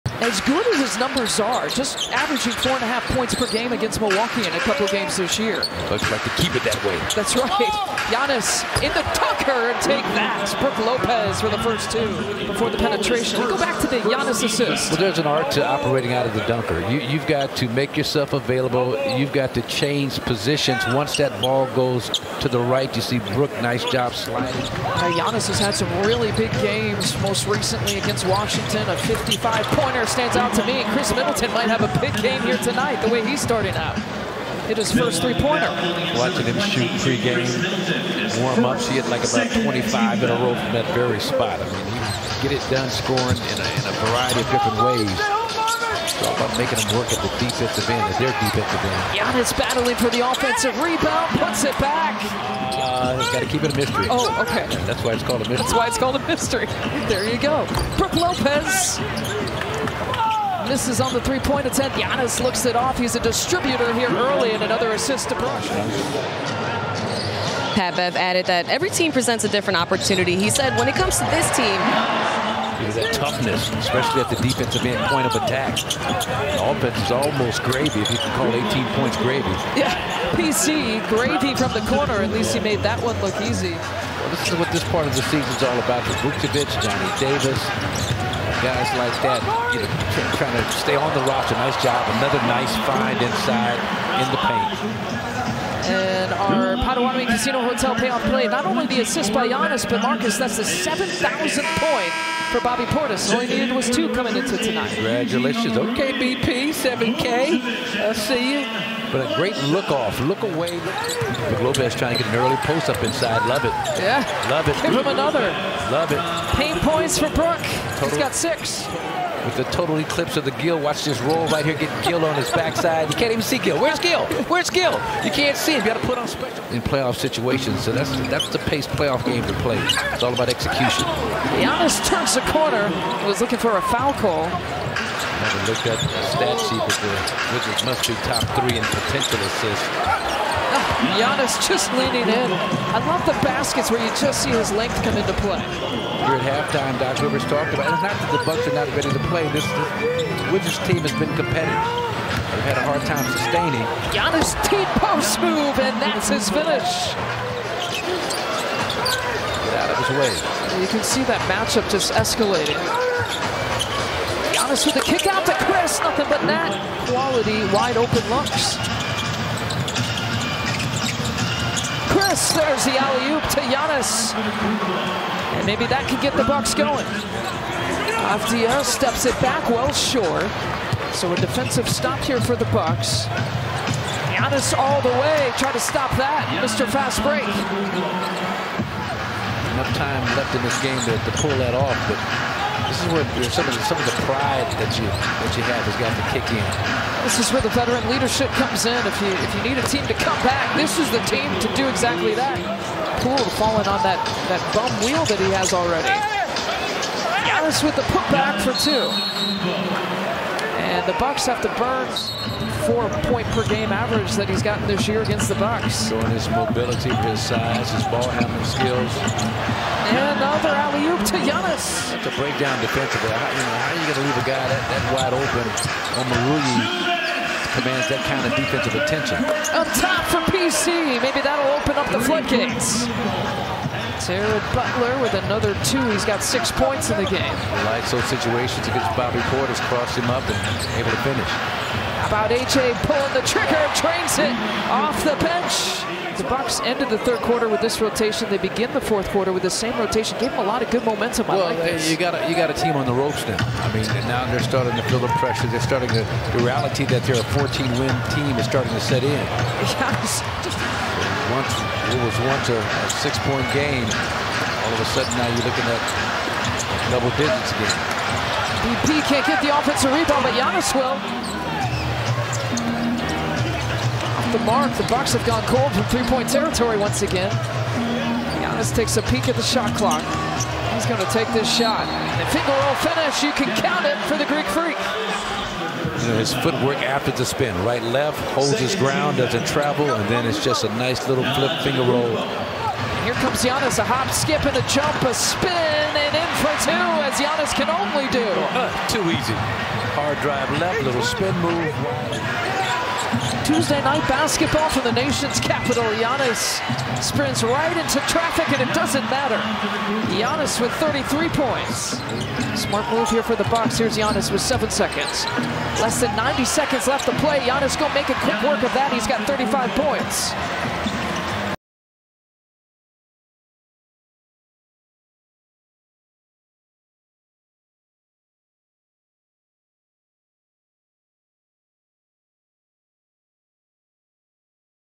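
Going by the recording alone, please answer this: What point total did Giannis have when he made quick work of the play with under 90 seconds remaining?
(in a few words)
35.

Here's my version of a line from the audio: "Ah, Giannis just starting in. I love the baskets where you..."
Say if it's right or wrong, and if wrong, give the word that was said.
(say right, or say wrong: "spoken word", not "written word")
wrong: "leaning", not "starting".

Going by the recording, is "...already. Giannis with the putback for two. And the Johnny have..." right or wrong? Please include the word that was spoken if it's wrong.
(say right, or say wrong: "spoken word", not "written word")
wrong: "Bucks", not "Johnny".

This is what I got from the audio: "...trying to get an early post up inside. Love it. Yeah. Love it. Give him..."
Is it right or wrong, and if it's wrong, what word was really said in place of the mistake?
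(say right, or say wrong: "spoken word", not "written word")
right.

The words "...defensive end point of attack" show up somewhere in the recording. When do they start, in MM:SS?
01:14.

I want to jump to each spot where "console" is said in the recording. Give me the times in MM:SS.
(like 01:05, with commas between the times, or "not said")
not said.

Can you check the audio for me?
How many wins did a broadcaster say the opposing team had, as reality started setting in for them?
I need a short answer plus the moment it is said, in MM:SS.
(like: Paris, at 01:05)
14, at 04:17.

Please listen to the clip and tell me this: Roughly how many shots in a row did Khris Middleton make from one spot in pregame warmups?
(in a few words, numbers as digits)
25.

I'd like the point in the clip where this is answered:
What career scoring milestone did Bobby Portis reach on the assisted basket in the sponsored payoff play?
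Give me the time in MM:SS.
01:40.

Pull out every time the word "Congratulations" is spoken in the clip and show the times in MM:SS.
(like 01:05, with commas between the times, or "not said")
01:44.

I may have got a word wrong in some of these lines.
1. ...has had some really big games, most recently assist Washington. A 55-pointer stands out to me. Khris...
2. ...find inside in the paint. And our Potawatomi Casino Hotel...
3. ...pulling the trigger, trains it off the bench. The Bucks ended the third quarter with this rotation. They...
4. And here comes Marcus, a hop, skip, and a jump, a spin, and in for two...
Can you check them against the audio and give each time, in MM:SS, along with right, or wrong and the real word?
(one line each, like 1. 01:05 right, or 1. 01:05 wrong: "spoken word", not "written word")
1. 00:25 wrong: "against", not "assist"
2. 01:32 right
3. 04:03 right
4. 04:52 wrong: "Giannis", not "Marcus".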